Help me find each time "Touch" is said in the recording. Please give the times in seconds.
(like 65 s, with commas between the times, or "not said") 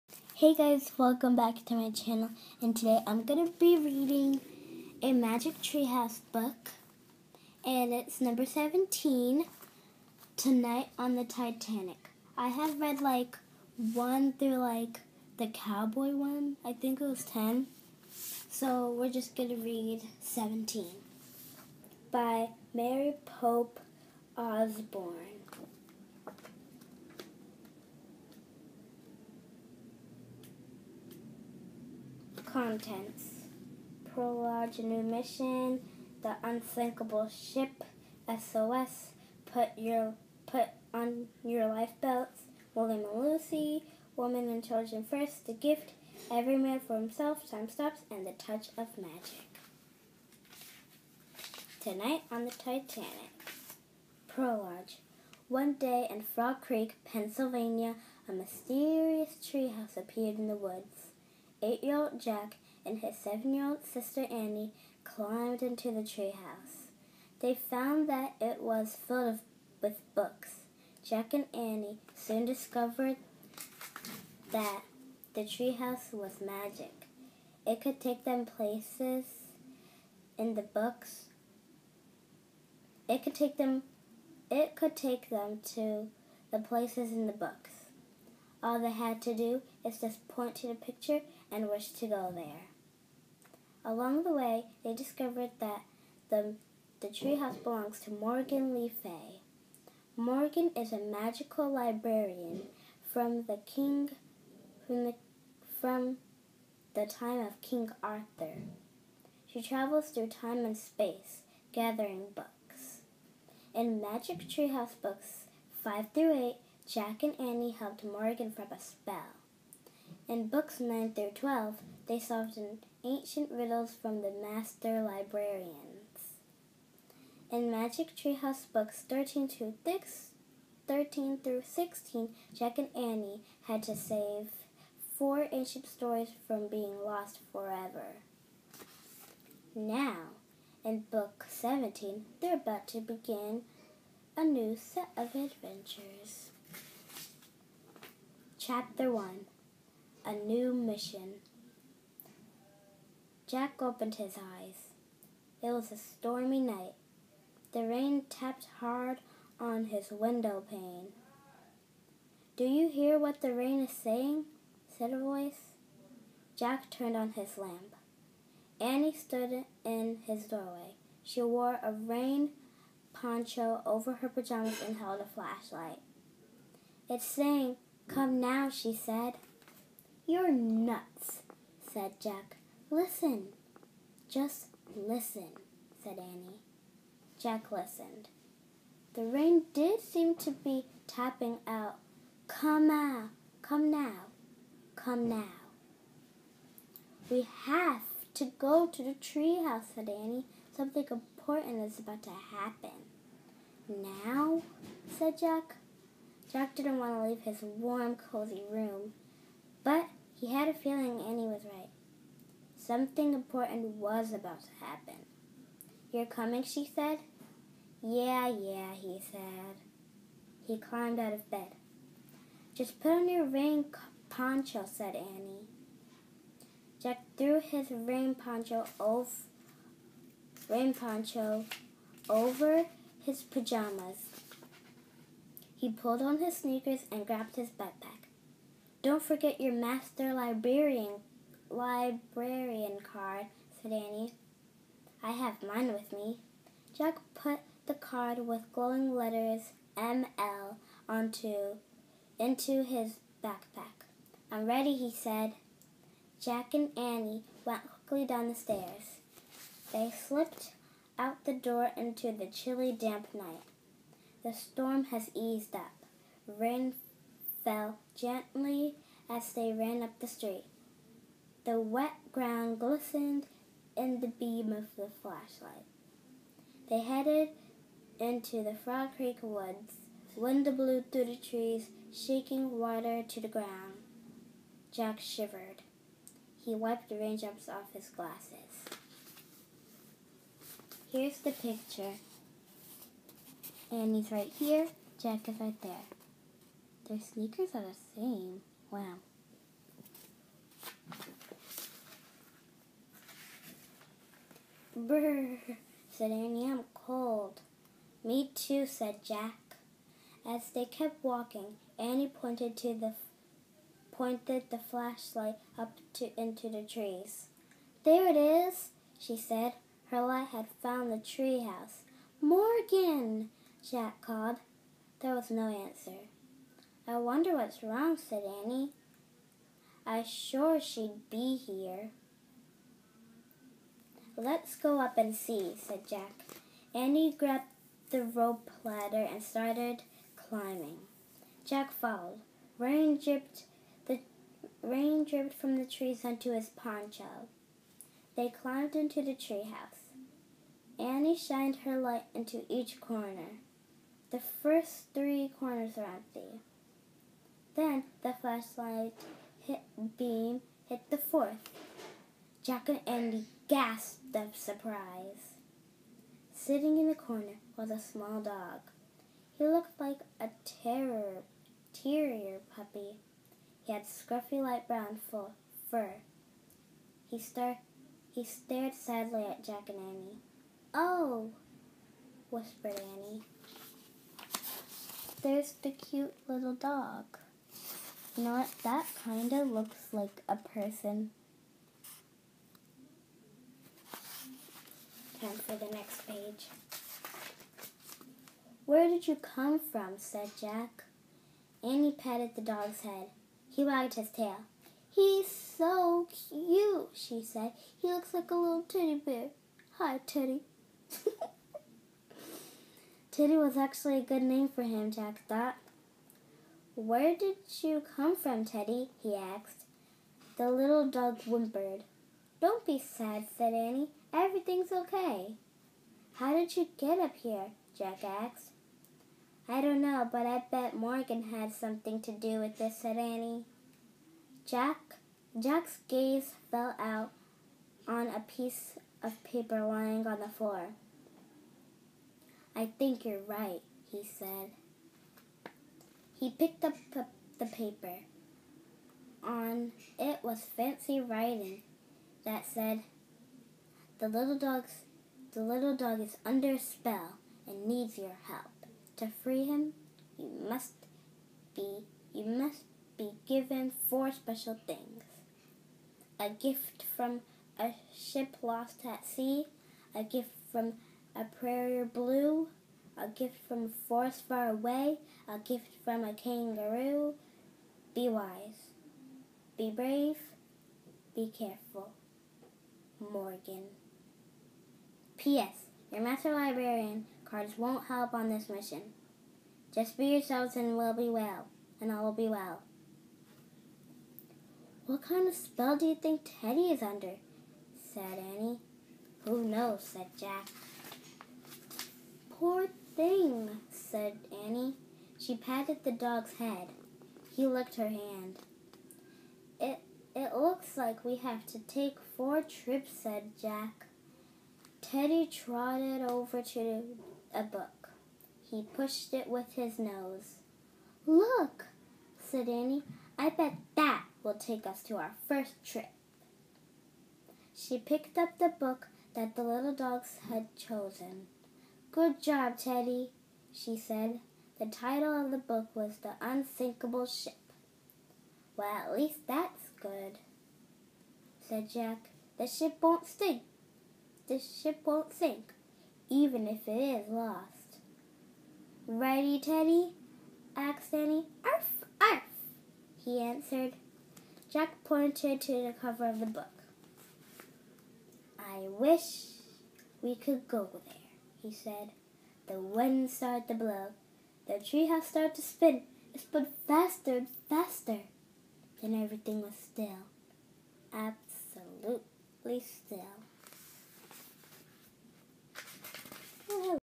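48 s.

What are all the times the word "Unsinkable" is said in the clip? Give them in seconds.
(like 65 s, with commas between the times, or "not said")
36 s, 536 s.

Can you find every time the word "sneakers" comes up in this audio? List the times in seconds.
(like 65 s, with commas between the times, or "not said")
236 s, 297 s.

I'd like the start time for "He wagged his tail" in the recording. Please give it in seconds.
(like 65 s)
403 s.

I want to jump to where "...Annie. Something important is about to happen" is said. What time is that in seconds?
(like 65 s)
200 s.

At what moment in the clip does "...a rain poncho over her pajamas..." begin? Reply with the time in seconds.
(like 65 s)
171 s.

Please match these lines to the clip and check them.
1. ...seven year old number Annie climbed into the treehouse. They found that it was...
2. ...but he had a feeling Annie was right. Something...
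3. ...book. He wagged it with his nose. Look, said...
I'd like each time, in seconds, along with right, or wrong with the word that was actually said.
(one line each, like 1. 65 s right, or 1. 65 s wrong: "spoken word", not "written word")
1. 63 s wrong: "sister", not "number"
2. 209 s right
3. 517 s wrong: "pushed", not "wagged".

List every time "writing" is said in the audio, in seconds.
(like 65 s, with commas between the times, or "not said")
451 s.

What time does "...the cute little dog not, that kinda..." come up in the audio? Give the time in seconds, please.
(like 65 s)
385 s.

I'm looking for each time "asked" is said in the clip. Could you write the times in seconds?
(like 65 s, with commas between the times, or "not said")
419 s, 428 s, 550 s.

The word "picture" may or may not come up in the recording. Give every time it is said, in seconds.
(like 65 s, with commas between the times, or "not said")
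90 s, 291 s.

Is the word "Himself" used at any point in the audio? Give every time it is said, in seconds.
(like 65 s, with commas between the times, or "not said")
46 s.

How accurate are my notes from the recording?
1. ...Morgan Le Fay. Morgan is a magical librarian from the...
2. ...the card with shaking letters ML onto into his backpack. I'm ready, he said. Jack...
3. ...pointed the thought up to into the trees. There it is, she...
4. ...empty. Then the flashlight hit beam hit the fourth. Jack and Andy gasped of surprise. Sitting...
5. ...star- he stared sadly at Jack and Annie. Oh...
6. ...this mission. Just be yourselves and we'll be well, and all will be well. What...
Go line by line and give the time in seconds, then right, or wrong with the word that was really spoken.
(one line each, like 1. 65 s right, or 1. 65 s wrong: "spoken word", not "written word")
1. 98 s right
2. 247 s wrong: "glowing", not "shaking"
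3. 314 s wrong: "flashlight", not "thought"
4. 356 s right
5. 377 s right
6. 488 s right.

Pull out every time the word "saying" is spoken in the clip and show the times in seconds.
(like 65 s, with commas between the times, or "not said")
163 s, 177 s.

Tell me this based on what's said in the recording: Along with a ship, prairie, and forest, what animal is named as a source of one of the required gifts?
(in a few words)
kangaroo.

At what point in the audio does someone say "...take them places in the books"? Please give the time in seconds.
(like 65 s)
78 s.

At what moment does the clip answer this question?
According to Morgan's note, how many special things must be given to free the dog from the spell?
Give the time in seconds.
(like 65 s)
464 s.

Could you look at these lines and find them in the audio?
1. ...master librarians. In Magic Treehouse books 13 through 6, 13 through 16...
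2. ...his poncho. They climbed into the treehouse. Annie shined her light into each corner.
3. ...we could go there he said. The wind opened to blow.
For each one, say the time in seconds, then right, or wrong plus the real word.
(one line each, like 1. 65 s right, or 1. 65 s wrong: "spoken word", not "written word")
1. 124 s right
2. 346 s right
3. 560 s wrong: "started", not "opened".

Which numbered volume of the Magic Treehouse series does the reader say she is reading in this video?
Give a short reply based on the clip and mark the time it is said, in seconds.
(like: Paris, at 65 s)
17, at 8 s.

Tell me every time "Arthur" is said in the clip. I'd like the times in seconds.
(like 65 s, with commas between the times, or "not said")
108 s.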